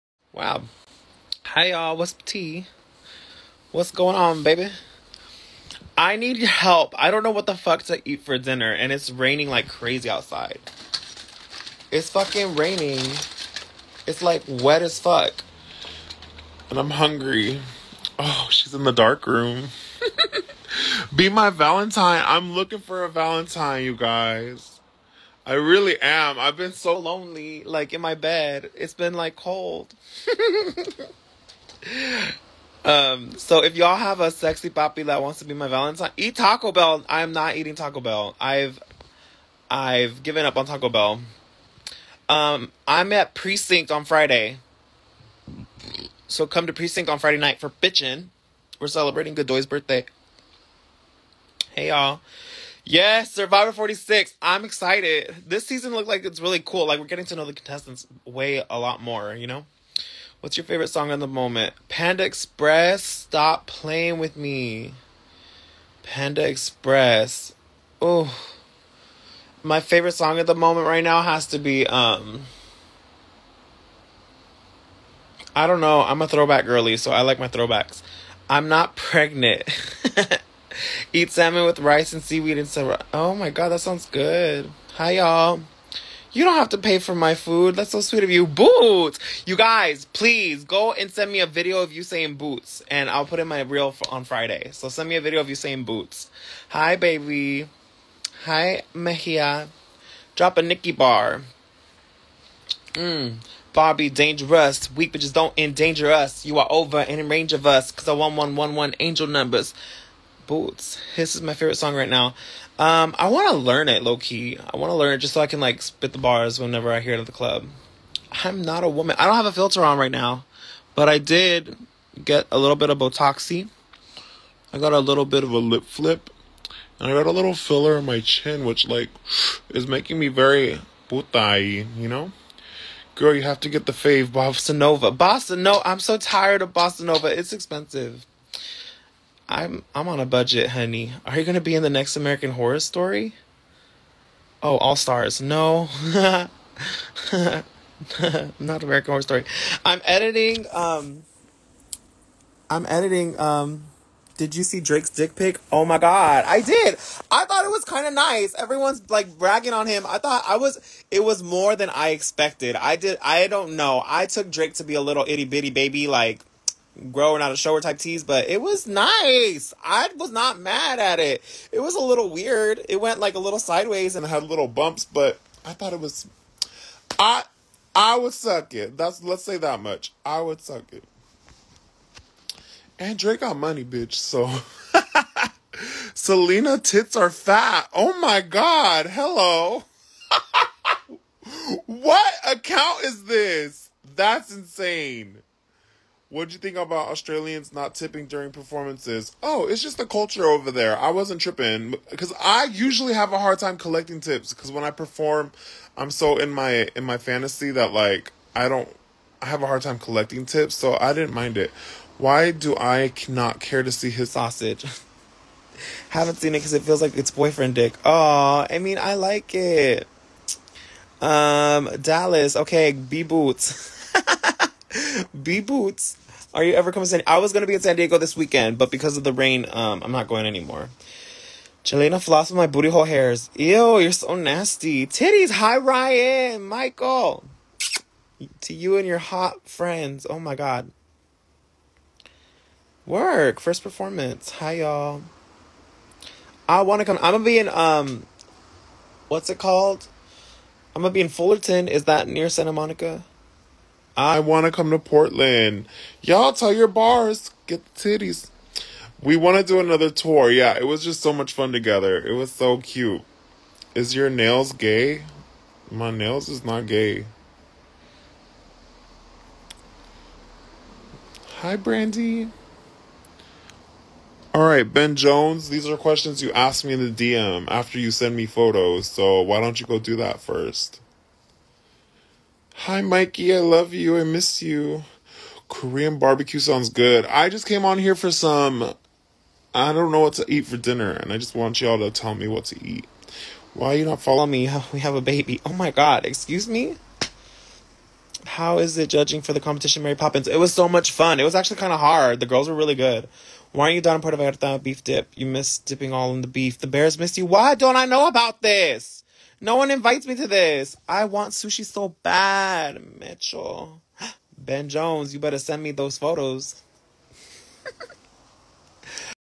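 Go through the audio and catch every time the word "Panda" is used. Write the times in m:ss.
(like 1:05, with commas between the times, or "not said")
1:01, 1:06.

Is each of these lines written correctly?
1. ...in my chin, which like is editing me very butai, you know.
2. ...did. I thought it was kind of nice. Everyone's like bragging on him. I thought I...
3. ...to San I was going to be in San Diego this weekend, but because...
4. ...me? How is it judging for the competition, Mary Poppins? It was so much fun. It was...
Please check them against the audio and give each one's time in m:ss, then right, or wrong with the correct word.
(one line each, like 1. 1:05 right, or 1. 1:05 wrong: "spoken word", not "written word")
1. 2:07 wrong: "making", not "editing"
2. 2:36 right
3. 3:47 right
4. 4:56 right.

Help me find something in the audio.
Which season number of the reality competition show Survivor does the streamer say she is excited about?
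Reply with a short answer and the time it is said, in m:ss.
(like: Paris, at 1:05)
46, at 0:53.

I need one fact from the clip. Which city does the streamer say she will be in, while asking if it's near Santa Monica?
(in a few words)
Fullerton.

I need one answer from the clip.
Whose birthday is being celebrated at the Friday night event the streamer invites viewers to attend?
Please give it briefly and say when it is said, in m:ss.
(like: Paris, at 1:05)
Goodoy's, at 0:49.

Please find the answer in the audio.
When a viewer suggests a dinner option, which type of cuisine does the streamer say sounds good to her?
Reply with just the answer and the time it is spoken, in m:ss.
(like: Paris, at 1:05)
Korean barbecue, at 4:45.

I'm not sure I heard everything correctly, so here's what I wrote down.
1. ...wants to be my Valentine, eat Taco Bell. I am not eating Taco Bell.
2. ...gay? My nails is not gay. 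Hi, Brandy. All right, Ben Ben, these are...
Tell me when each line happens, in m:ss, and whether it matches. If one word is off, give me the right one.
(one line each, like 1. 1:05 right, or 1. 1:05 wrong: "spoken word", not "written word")
1. 0:35 right
2. 4:24 wrong: "Jones", not "Ben".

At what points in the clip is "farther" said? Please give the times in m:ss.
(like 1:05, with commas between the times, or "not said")
not said.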